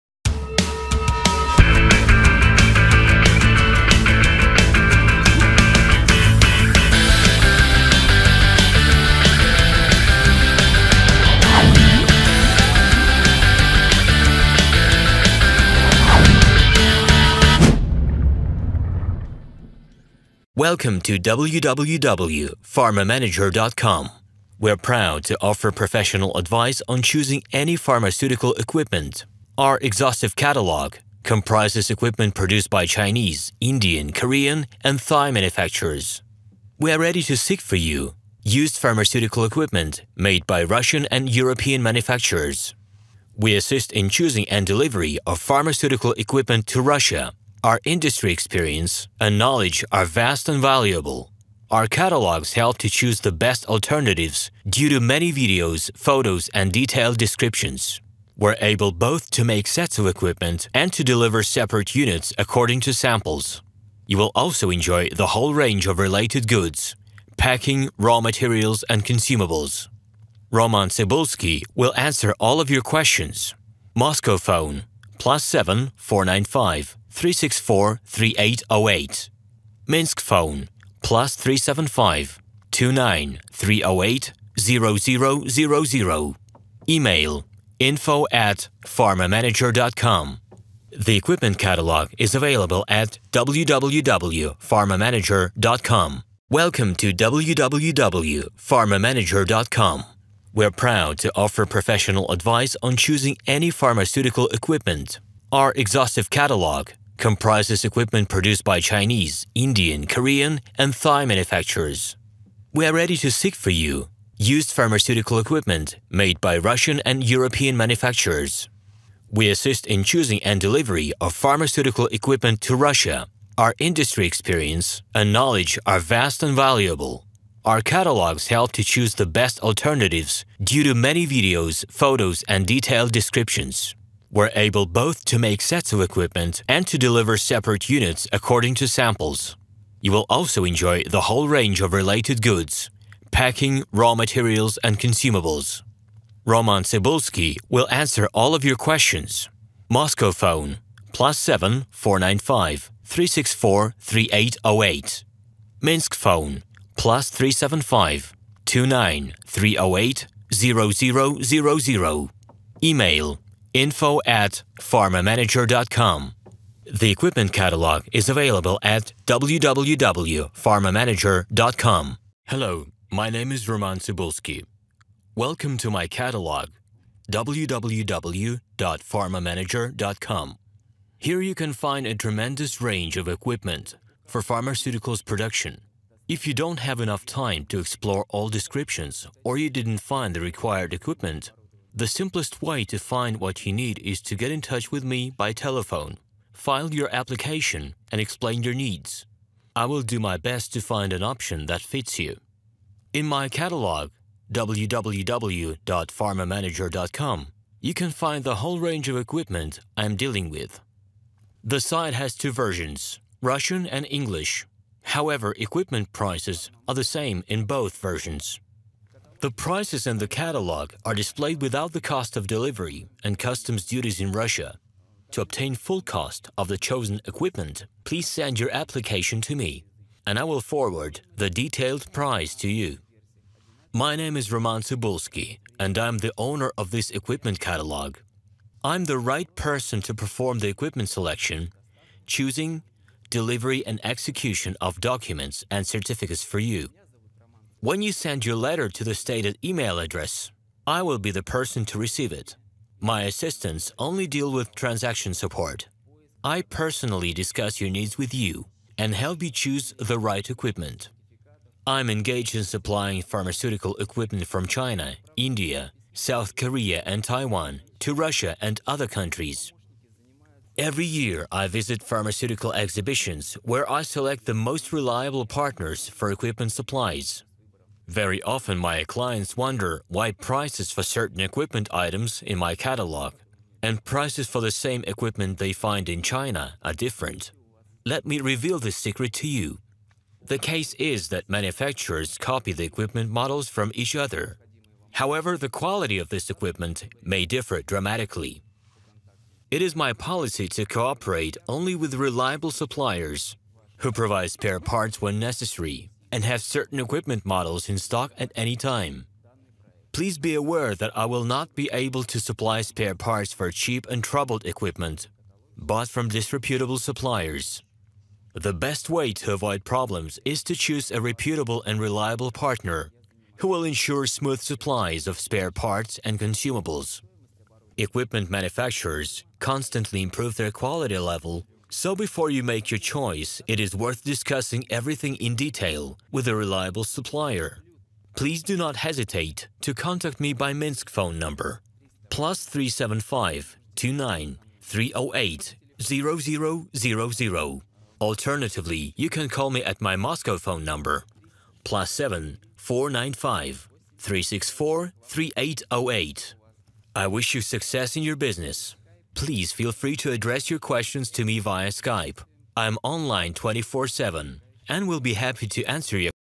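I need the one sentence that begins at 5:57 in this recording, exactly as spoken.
I wish you success in your business please feel free to address your questions to me via Skype.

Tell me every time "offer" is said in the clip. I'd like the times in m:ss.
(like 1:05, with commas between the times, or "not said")
0:25, 1:41.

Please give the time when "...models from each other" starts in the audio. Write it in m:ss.
4:53.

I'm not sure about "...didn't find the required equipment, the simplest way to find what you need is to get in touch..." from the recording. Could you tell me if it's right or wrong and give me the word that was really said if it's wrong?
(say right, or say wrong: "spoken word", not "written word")
right.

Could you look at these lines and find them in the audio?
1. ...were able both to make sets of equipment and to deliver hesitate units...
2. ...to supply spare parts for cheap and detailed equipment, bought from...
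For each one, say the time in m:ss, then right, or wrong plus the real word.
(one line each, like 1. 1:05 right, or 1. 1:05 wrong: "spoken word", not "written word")
1. 2:14 wrong: "separate", not "hesitate"
2. 5:12 wrong: "troubled", not "detailed".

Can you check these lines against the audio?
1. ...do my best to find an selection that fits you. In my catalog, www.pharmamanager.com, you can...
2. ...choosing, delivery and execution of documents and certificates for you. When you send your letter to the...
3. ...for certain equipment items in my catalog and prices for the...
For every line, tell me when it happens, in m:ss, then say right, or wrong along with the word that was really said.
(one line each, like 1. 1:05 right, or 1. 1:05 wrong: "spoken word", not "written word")
1. 3:20 wrong: "option", not "selection"
2. 4:02 right
3. 4:40 right.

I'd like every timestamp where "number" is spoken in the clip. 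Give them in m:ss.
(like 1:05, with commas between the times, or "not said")
5:41, 5:50.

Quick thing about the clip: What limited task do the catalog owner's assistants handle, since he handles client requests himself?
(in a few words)
Transaction support.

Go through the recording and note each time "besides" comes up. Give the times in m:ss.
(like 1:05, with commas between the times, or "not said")
not said.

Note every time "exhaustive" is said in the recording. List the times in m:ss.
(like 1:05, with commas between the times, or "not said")
0:29, 1:45.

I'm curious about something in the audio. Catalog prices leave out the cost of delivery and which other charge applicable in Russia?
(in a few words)
Customs duties.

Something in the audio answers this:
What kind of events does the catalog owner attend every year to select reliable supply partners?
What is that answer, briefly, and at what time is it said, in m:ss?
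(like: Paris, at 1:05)
Pharmaceutical exhibitions, at 4:32.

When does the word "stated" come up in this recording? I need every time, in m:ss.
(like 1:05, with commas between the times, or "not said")
4:09.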